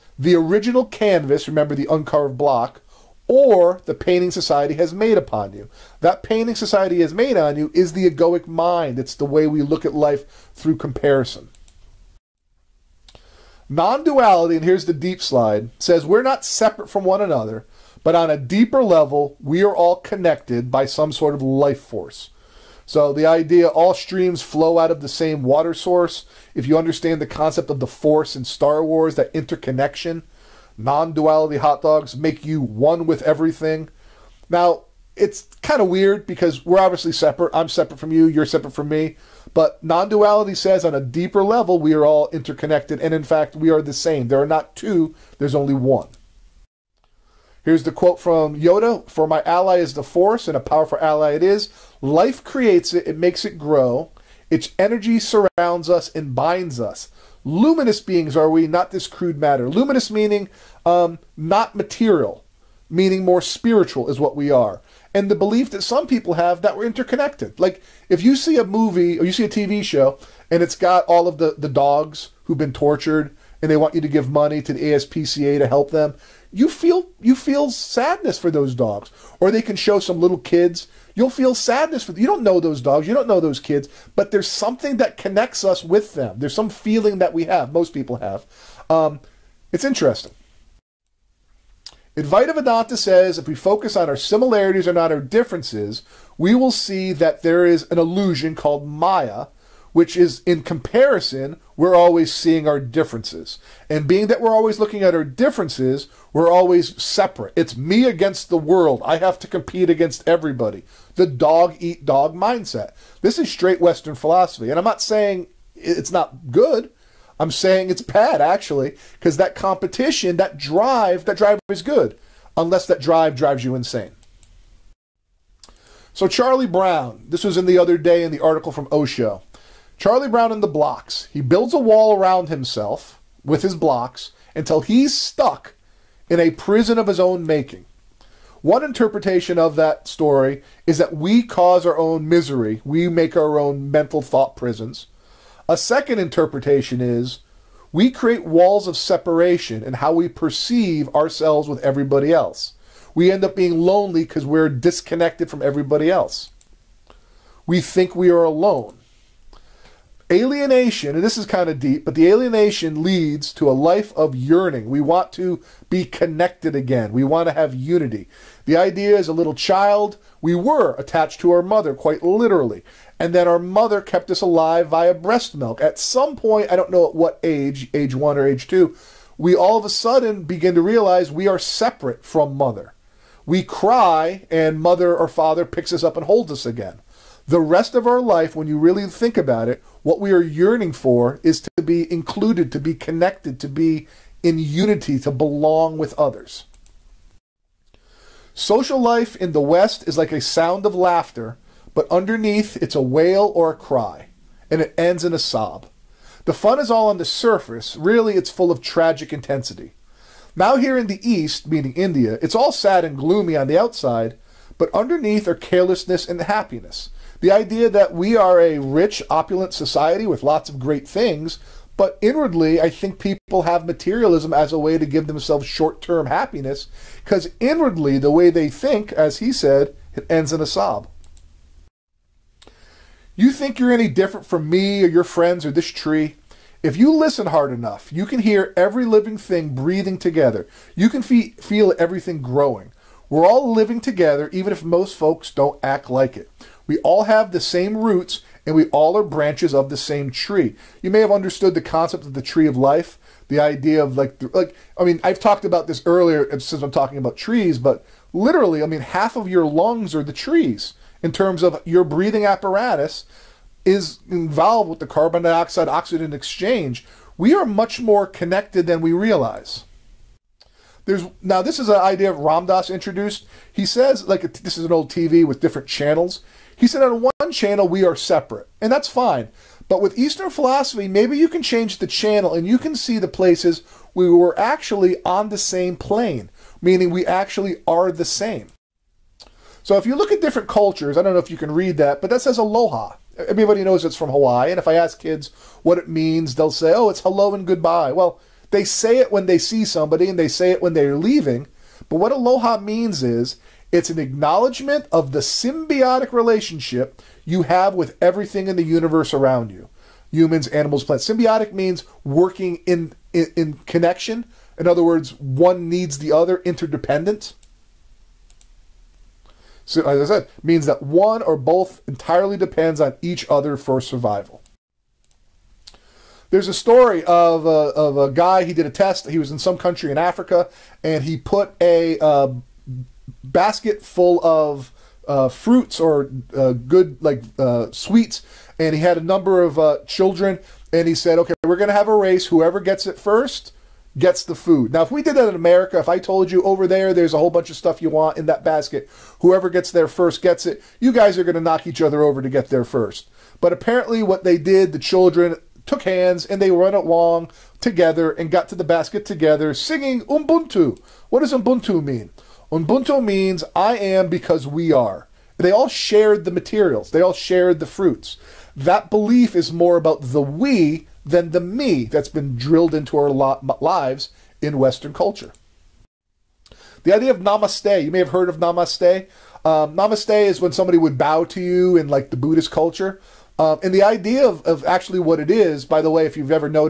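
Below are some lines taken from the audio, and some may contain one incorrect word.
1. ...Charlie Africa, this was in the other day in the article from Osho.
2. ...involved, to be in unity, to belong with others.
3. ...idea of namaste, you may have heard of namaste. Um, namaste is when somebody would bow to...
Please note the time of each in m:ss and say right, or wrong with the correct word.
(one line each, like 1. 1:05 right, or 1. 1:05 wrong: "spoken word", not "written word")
1. 2:06 wrong: "Brown", not "Africa"
2. 3:12 wrong: "connected", not "involved"
3. 6:17 right.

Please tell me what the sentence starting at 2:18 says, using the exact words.
One interpretation of that story is that we cause our own misery.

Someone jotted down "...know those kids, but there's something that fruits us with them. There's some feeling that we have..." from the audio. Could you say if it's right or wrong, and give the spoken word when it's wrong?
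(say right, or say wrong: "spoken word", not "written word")
wrong: "connects", not "fruits".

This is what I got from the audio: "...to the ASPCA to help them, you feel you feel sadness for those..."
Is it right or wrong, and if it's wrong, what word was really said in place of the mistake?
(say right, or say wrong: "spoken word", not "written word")
right.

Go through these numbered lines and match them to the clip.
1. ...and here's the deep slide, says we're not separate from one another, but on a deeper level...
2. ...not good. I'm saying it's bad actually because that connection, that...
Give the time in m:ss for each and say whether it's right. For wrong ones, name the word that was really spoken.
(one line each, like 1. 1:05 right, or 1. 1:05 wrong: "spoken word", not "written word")
1. 0:14 right
2. 1:56 wrong: "competition", not "connection".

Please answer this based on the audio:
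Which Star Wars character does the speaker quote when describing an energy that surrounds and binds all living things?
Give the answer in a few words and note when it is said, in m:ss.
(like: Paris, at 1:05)
Yoda, at 0:48.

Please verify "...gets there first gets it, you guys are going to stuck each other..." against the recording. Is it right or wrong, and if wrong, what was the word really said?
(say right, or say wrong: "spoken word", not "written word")
wrong: "knock", not "stuck".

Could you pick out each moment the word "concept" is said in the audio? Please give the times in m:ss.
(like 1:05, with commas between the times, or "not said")
0:27, 4:11.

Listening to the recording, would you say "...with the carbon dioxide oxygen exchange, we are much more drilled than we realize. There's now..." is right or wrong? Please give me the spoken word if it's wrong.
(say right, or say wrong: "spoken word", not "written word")
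wrong: "connected", not "drilled".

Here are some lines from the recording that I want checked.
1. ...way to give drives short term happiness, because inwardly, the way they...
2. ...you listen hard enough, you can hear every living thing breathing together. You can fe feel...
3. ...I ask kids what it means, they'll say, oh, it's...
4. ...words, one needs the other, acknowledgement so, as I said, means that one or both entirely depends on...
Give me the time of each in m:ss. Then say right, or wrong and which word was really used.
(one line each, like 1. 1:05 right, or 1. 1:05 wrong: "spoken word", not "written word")
1. 3:44 wrong: "themselves", not "drives"
2. 3:56 right
3. 4:54 right
4. 5:15 wrong: "interdependent", not "acknowledgement".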